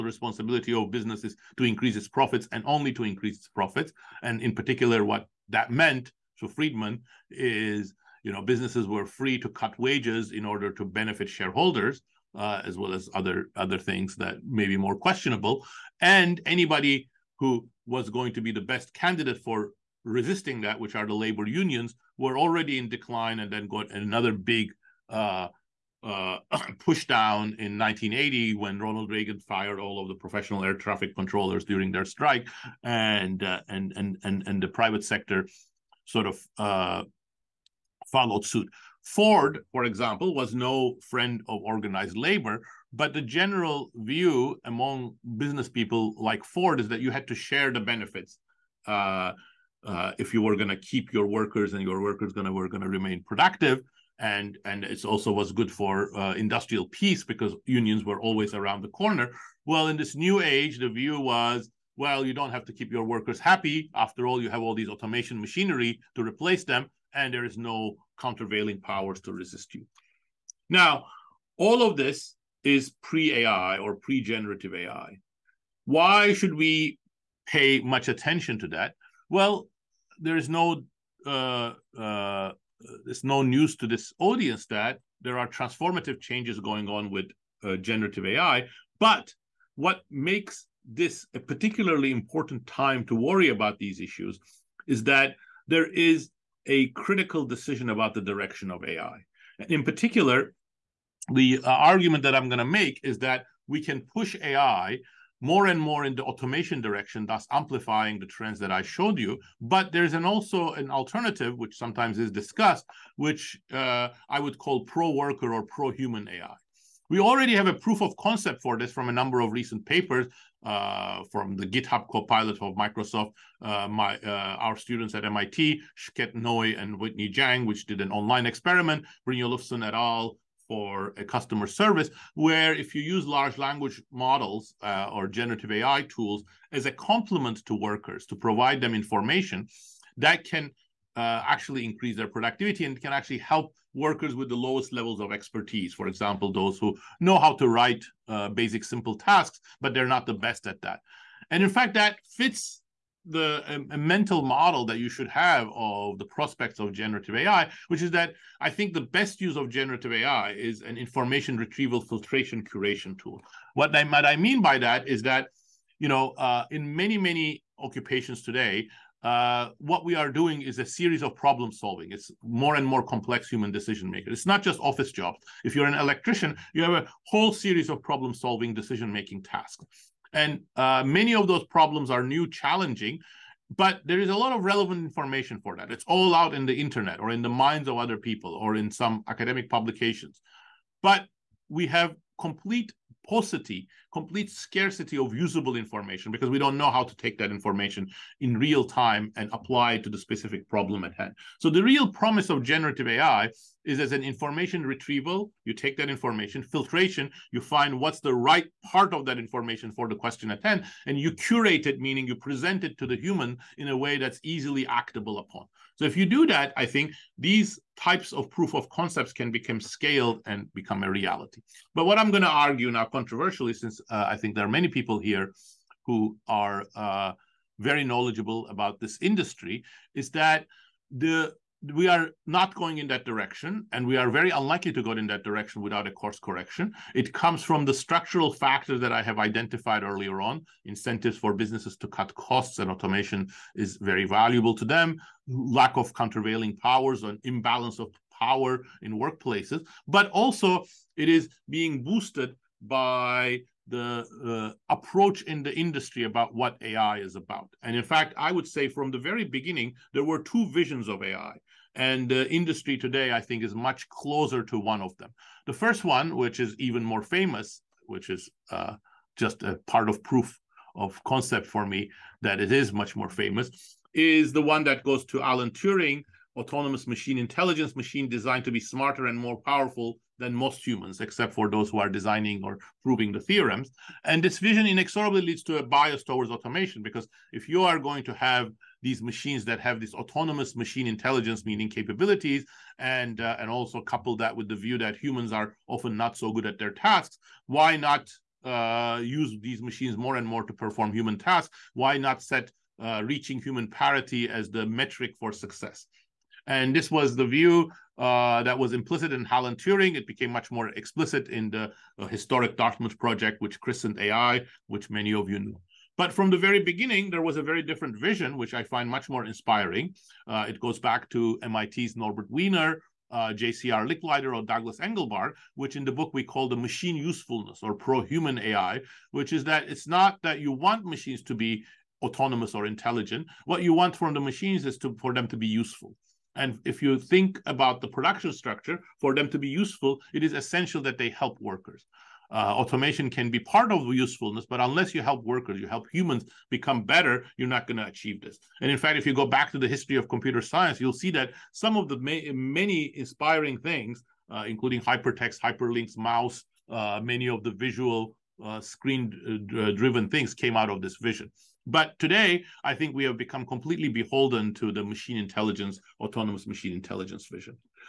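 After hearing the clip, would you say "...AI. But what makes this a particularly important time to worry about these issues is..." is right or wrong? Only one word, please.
right.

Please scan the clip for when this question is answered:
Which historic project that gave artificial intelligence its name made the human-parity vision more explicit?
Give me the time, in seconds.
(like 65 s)
312 s.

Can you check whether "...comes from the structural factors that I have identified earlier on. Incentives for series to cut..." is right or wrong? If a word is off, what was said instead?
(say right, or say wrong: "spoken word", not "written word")
wrong: "businesses", not "series".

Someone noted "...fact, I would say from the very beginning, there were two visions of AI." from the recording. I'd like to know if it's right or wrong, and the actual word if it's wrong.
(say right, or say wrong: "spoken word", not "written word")
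right.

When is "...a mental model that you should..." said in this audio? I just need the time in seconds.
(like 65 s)
153 s.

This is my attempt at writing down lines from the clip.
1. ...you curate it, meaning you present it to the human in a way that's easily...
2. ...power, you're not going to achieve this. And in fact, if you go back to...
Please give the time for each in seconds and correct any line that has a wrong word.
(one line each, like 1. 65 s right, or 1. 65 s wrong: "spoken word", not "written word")
1. 211 s right
2. 347 s wrong: "better", not "power".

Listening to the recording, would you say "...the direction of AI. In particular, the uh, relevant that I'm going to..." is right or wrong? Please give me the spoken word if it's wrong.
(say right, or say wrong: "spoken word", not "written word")
wrong: "argument", not "relevant".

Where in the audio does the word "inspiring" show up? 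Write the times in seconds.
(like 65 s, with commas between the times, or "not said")
319 s, 353 s.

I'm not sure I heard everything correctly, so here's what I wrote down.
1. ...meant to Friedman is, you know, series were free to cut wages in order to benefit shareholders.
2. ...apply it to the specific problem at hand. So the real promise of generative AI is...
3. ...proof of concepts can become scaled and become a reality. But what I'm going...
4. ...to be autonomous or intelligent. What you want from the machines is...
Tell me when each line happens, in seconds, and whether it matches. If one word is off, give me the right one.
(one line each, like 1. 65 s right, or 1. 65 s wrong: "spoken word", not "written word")
1. 5 s wrong: "businesses", not "series"
2. 199 s right
3. 218 s right
4. 331 s right.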